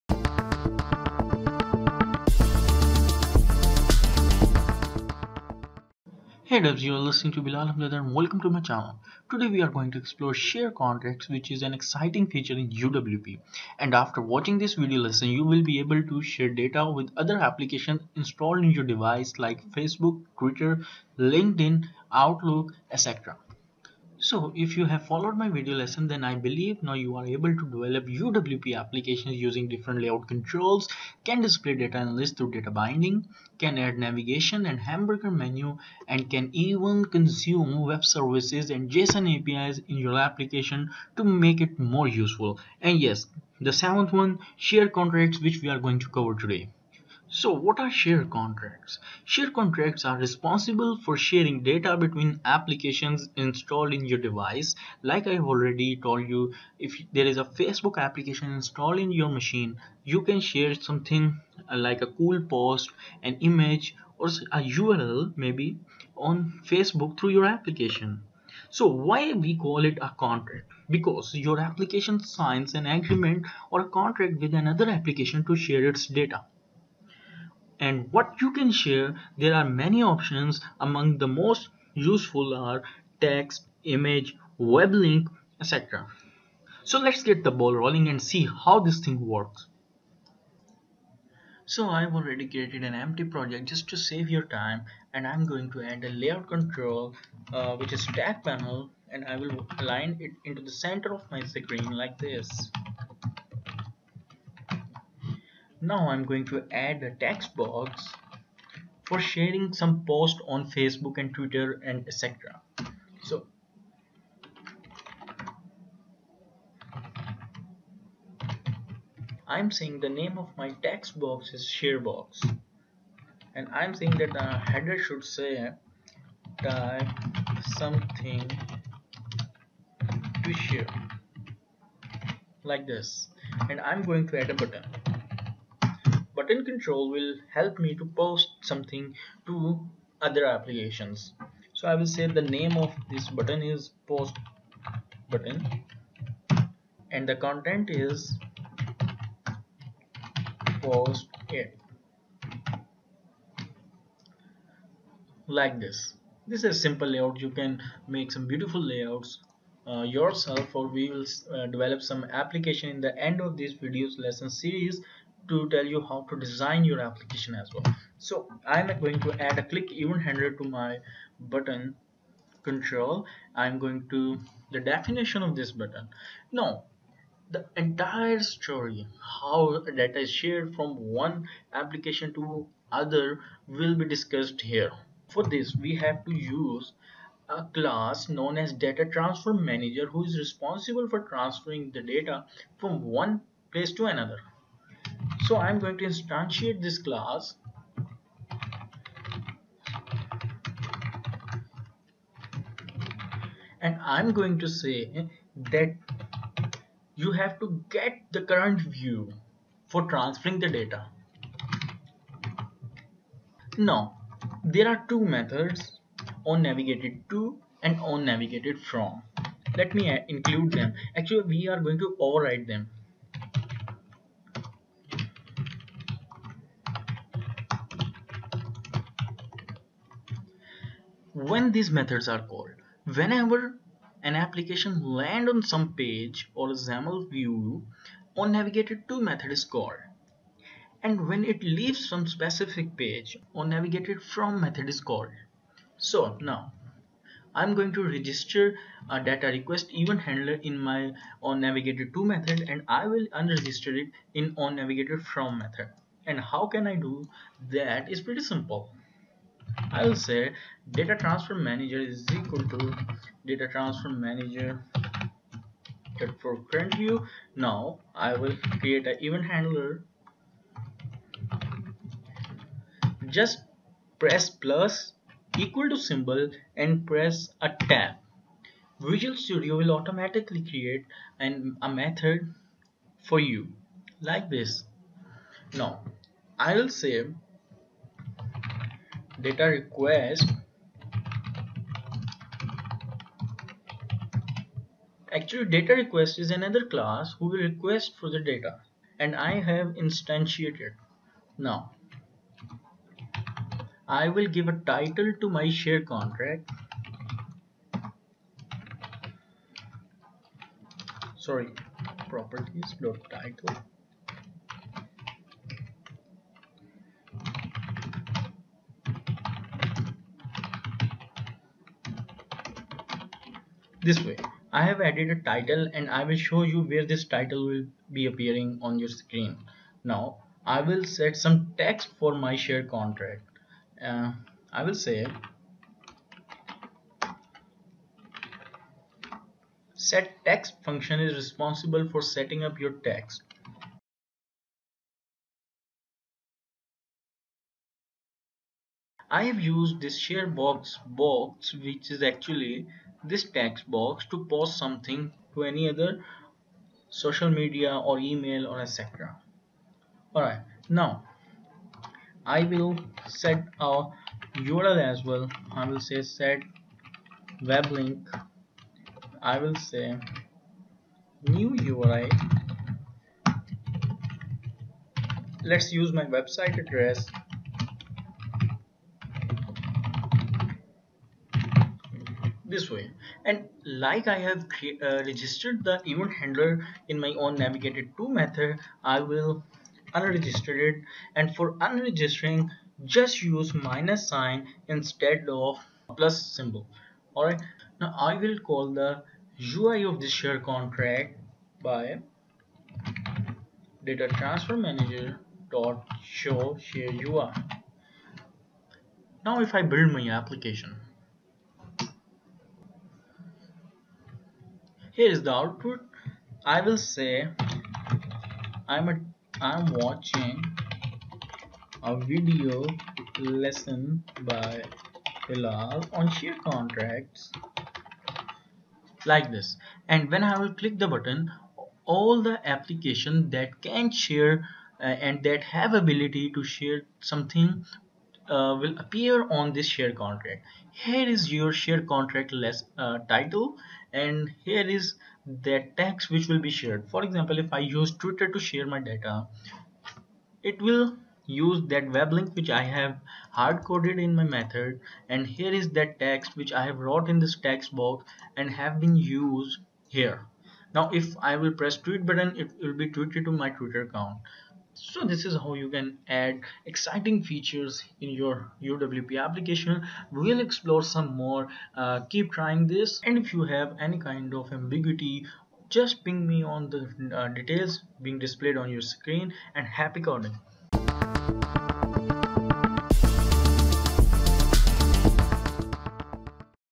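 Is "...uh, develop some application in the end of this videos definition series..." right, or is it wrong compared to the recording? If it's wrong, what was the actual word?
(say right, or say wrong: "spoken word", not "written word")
wrong: "lesson", not "definition".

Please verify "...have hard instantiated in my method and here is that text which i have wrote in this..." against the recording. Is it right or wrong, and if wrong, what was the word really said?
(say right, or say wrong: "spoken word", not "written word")
wrong: "coded", not "instantiated".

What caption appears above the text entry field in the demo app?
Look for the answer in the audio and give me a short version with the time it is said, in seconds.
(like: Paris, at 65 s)
type something to share, at 126 s.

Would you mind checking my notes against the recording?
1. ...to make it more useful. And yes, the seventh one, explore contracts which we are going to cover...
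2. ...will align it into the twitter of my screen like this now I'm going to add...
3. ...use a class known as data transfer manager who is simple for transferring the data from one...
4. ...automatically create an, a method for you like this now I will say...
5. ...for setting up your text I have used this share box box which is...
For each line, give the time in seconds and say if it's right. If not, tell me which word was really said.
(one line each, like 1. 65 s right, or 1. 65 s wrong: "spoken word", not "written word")
1. 41 s wrong: "share", not "explore"
2. 99 s wrong: "center", not "twitter"
3. 186 s wrong: "responsible", not "simple"
4. 279 s right
5. 342 s right.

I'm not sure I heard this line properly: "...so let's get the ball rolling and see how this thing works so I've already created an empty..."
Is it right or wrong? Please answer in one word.
right.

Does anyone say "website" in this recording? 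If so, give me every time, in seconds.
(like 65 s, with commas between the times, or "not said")
376 s.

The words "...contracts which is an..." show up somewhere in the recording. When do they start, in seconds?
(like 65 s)
10 s.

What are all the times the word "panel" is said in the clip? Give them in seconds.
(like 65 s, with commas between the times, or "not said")
98 s.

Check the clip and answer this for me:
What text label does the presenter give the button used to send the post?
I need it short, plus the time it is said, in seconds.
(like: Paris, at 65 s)
post it, at 150 s.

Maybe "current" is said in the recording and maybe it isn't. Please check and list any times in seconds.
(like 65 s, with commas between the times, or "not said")
208 s, 266 s.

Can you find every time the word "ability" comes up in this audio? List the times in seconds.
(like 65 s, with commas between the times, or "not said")
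435 s.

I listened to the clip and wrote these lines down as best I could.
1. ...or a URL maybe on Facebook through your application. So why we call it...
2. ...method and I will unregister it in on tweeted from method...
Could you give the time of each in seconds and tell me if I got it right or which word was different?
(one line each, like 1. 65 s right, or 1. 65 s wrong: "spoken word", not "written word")
1. 64 s right
2. 252 s wrong: "navigated", not "tweeted".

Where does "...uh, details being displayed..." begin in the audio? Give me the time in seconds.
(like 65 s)
477 s.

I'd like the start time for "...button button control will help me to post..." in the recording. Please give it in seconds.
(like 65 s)
134 s.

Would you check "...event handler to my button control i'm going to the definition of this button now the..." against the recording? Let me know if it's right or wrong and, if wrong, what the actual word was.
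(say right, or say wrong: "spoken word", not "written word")
right.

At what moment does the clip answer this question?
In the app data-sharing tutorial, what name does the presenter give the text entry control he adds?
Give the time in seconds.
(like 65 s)
121 s.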